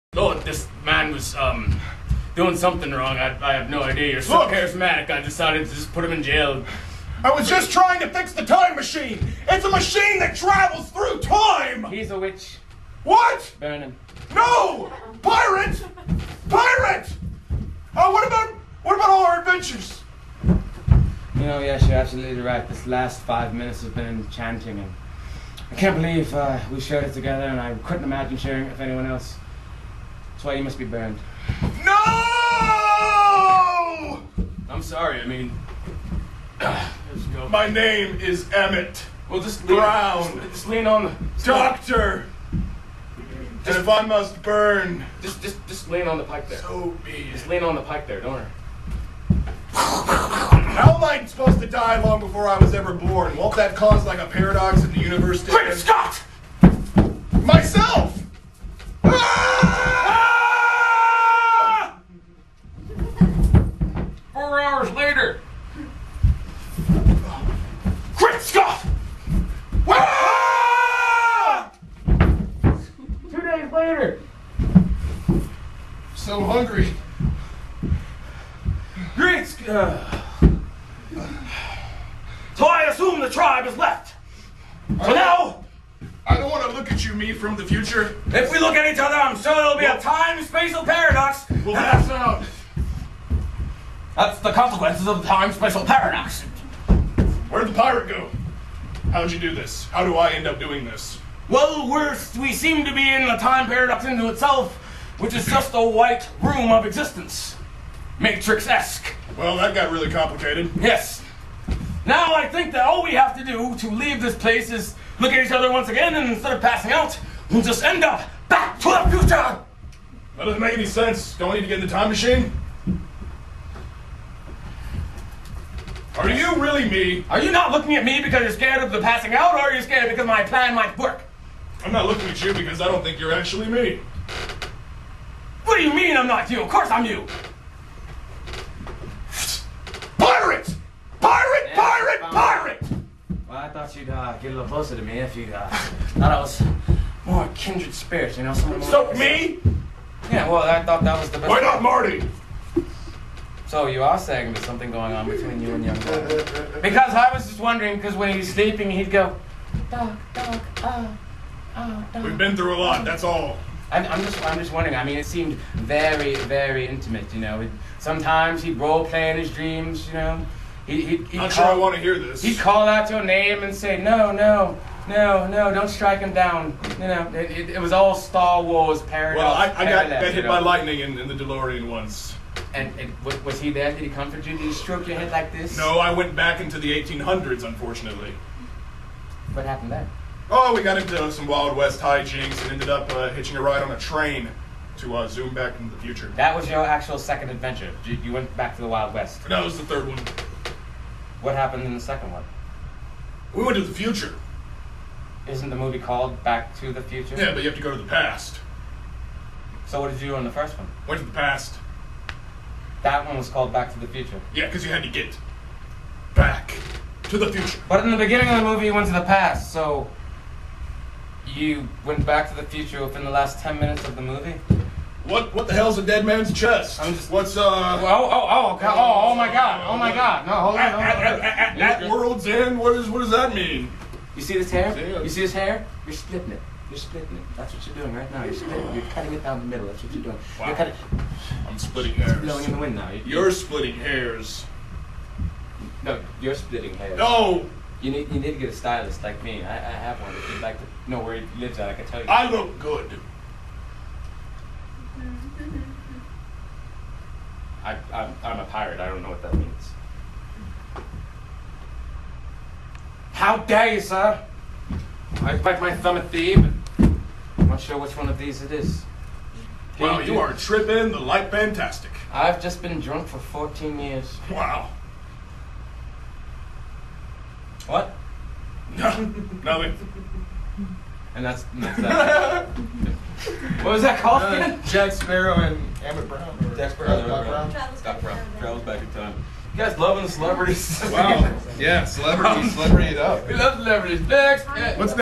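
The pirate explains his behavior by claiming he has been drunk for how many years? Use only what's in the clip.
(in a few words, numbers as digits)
14.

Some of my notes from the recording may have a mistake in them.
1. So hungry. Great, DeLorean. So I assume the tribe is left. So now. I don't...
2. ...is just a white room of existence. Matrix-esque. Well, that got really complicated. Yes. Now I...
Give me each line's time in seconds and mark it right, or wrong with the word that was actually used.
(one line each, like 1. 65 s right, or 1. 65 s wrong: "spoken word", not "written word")
1. 76 s wrong: "Scott", not "DeLorean"
2. 105 s right.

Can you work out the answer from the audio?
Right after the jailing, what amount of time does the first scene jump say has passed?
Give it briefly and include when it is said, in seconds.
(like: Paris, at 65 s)
hours later, at 64 s.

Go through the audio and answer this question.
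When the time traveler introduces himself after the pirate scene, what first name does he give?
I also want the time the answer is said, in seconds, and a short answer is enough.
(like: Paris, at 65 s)
Emmett, at 37 s.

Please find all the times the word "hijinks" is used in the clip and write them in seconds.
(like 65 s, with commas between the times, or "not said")
191 s.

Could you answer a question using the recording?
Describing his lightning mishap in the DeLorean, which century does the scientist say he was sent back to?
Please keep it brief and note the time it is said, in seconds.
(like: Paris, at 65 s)
1800s, at 187 s.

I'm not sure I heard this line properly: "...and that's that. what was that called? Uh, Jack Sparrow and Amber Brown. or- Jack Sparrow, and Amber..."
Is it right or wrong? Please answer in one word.
right.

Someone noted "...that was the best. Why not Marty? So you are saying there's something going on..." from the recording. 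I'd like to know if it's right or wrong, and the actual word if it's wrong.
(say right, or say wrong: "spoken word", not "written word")
right.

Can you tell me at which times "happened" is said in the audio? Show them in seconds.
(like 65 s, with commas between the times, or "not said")
189 s, 201 s.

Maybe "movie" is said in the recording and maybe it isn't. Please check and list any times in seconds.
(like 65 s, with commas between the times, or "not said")
205 s, 218 s, 224 s.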